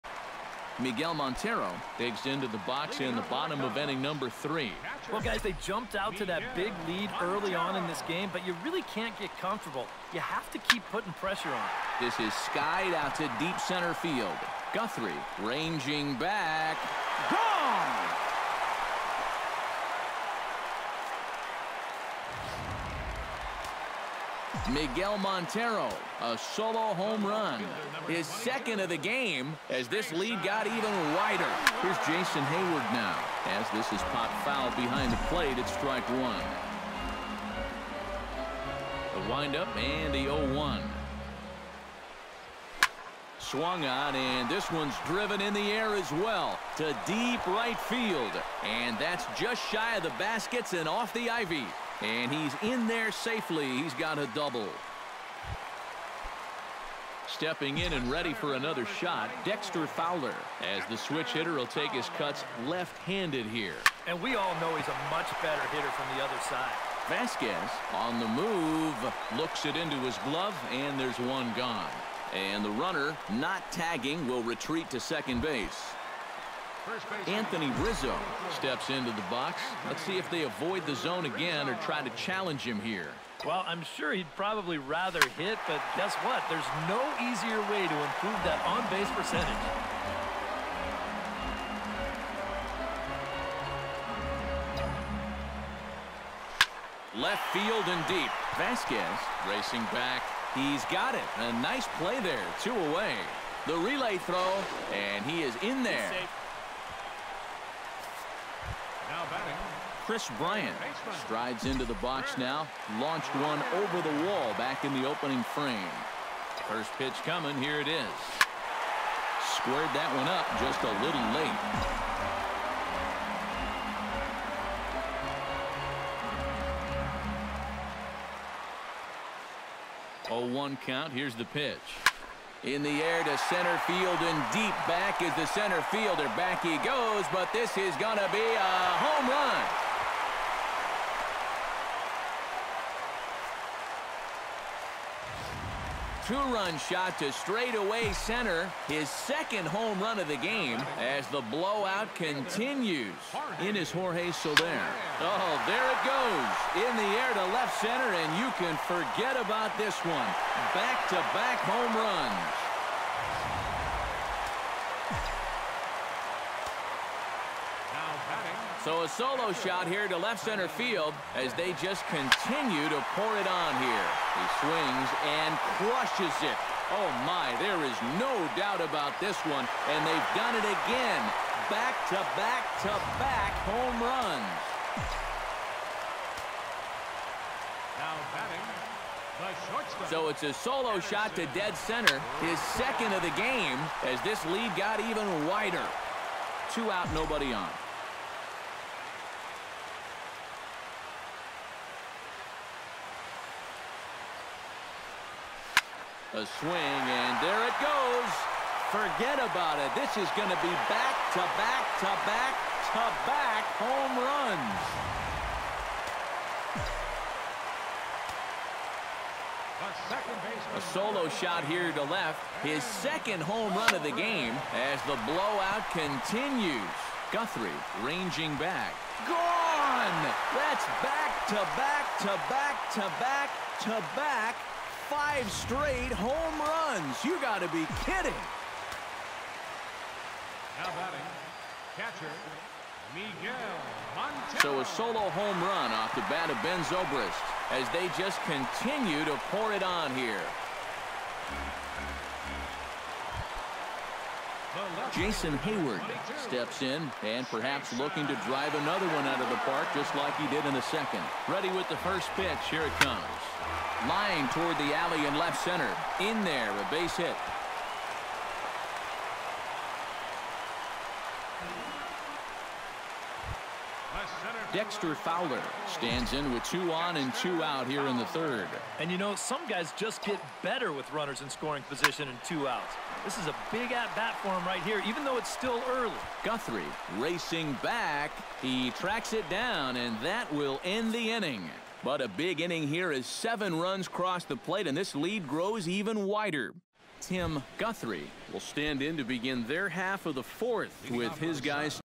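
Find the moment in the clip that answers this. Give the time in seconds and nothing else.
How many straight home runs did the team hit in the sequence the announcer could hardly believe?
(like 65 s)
235 s.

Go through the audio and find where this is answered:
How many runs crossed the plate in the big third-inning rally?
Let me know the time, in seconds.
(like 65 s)
293 s.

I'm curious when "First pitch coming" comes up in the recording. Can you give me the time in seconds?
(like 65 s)
116 s.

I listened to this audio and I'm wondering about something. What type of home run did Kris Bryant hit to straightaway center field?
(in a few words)
Two-run.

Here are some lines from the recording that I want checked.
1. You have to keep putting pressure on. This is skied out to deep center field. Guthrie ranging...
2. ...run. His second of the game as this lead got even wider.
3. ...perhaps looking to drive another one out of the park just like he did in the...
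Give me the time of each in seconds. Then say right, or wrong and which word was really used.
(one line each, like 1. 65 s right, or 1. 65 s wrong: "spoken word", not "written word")
1. 10 s right
2. 27 s right
3. 257 s right.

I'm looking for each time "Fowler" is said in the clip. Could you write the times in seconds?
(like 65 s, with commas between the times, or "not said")
59 s, 275 s.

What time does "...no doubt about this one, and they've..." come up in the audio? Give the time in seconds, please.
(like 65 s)
178 s.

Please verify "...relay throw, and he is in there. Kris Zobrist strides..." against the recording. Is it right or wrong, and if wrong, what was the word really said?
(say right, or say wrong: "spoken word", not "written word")
wrong: "Bryant", not "Zobrist".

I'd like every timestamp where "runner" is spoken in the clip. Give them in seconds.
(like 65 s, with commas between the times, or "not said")
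72 s, 281 s.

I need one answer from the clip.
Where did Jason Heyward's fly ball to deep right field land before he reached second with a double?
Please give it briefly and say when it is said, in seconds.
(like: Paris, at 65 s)
Off the ivy, at 50 s.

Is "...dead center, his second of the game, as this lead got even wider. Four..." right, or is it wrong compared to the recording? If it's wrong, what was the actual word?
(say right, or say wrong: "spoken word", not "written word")
wrong: "Two", not "Four".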